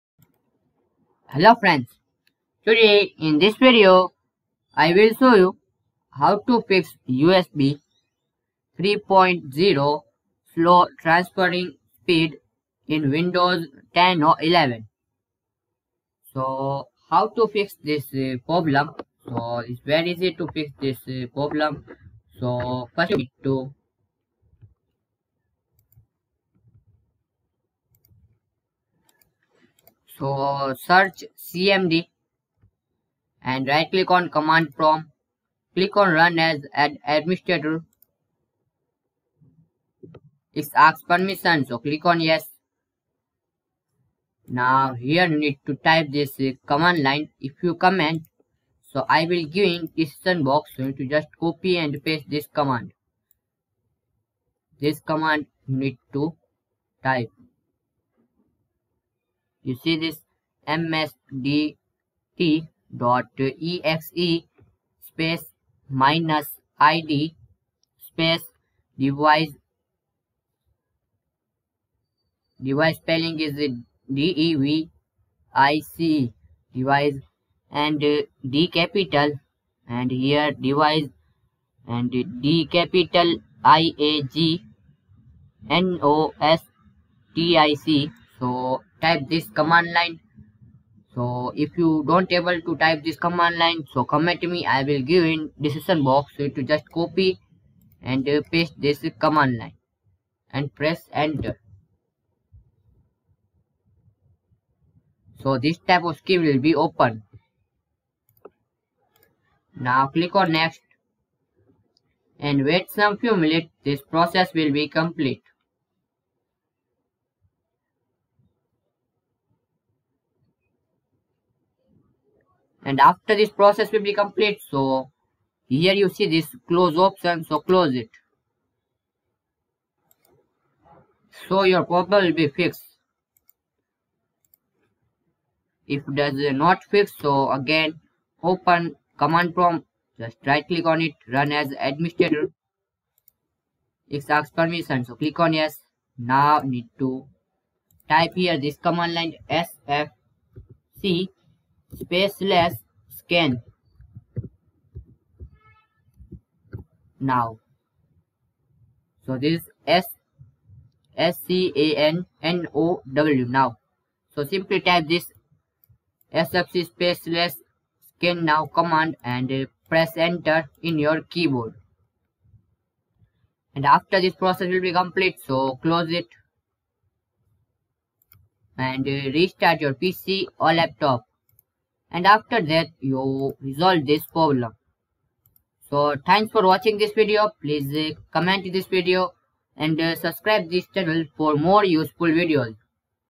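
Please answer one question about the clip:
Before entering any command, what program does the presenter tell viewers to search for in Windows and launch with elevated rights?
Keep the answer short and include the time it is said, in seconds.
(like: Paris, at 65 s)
CMD, at 31 s.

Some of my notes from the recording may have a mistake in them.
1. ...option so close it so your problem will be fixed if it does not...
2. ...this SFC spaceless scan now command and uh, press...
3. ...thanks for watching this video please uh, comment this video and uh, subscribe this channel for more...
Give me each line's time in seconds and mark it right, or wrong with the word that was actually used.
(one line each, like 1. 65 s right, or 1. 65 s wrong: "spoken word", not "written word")
1. 127 s right
2. 165 s right
3. 186 s right.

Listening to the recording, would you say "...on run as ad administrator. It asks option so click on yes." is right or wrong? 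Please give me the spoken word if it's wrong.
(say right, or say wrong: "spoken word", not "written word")
wrong: "permission", not "option".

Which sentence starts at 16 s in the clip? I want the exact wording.
So how to fix this uh, problem, so it's very easy to fix this uh, problem.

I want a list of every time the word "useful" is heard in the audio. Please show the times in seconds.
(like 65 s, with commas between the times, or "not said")
191 s.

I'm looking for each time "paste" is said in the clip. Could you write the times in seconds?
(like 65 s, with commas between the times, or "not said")
52 s, 98 s.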